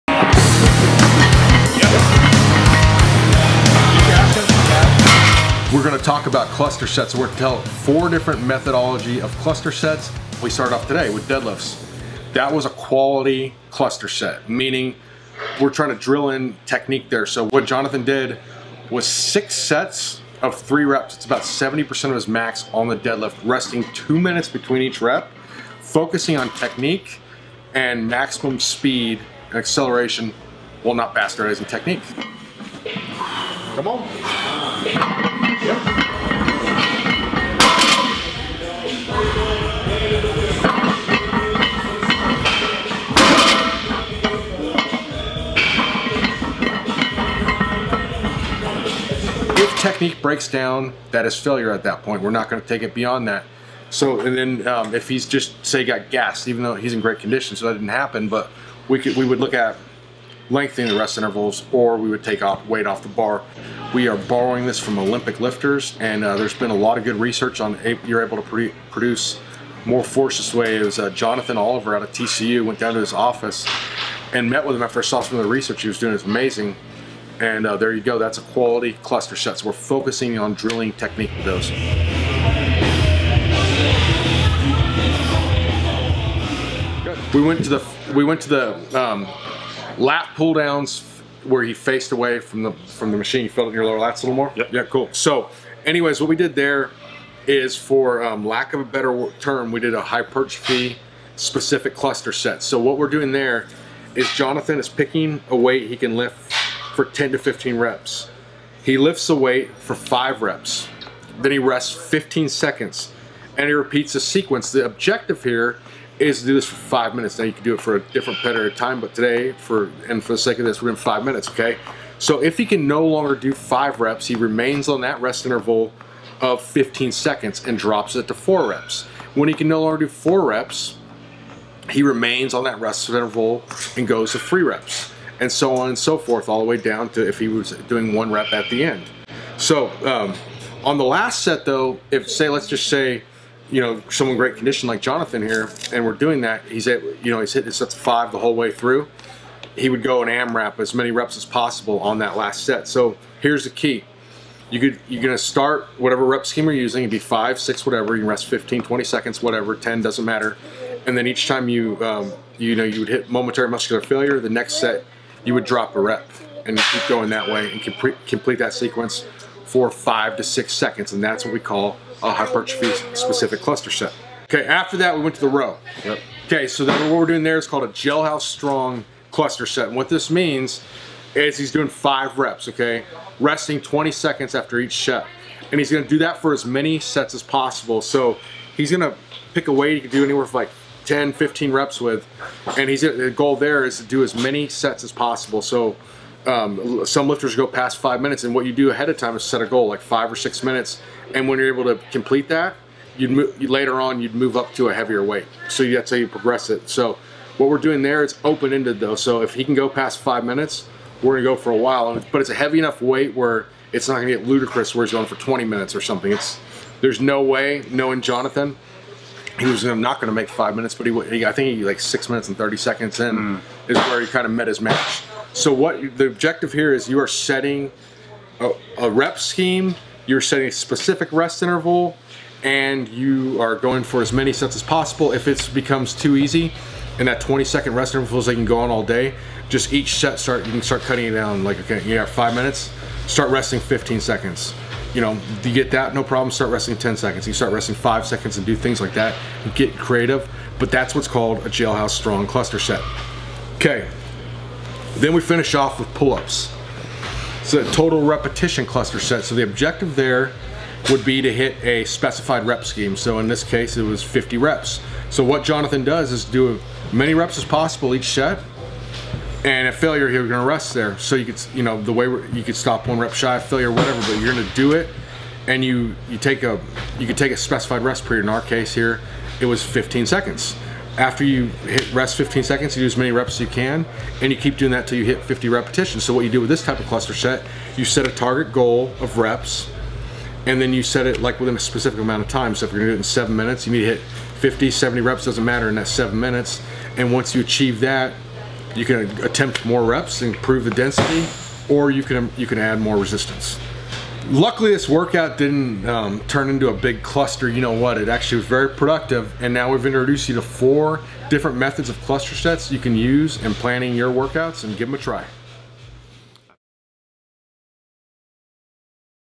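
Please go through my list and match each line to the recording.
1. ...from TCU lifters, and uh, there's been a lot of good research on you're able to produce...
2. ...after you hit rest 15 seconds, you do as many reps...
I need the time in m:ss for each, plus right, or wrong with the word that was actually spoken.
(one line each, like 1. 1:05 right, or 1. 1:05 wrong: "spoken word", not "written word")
1. 1:04 wrong: "Olympic", not "TCU"
2. 4:41 right.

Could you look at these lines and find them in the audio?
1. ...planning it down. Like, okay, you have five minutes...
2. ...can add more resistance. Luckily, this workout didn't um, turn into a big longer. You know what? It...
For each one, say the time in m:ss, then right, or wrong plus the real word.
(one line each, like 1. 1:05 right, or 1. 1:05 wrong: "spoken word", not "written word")
1. 4:01 wrong: "cutting", not "planning"
2. 5:02 wrong: "cluster", not "longer".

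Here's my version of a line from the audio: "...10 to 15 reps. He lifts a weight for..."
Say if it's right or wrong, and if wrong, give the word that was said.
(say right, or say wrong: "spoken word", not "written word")
right.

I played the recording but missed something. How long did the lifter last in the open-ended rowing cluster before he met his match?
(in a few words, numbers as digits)
6 minutes 30 seconds.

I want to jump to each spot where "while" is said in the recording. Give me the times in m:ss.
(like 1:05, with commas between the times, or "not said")
0:30, 3:31.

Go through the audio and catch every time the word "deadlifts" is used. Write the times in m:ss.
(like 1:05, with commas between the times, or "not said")
0:11, 0:22.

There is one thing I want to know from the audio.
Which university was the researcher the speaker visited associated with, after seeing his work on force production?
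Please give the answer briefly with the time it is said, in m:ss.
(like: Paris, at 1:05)
TCU, at 1:12.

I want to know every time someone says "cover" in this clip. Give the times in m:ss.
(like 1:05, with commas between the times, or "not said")
not said.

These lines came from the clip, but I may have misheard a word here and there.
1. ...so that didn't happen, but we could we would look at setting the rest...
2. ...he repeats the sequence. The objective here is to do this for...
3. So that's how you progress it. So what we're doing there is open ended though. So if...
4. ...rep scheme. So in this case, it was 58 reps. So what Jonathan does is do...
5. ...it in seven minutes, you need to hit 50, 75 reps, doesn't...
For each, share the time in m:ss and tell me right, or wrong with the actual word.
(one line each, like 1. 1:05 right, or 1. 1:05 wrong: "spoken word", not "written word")
1. 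0:57 wrong: "lengthening", not "setting"
2. 1:53 right
3. 3:25 right
4. 4:22 wrong: "50", not "58"
5. 4:53 wrong: "70", not "75".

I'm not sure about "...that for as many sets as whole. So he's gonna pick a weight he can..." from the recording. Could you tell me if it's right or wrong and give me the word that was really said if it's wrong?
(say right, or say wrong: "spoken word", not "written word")
wrong: "possible", not "whole".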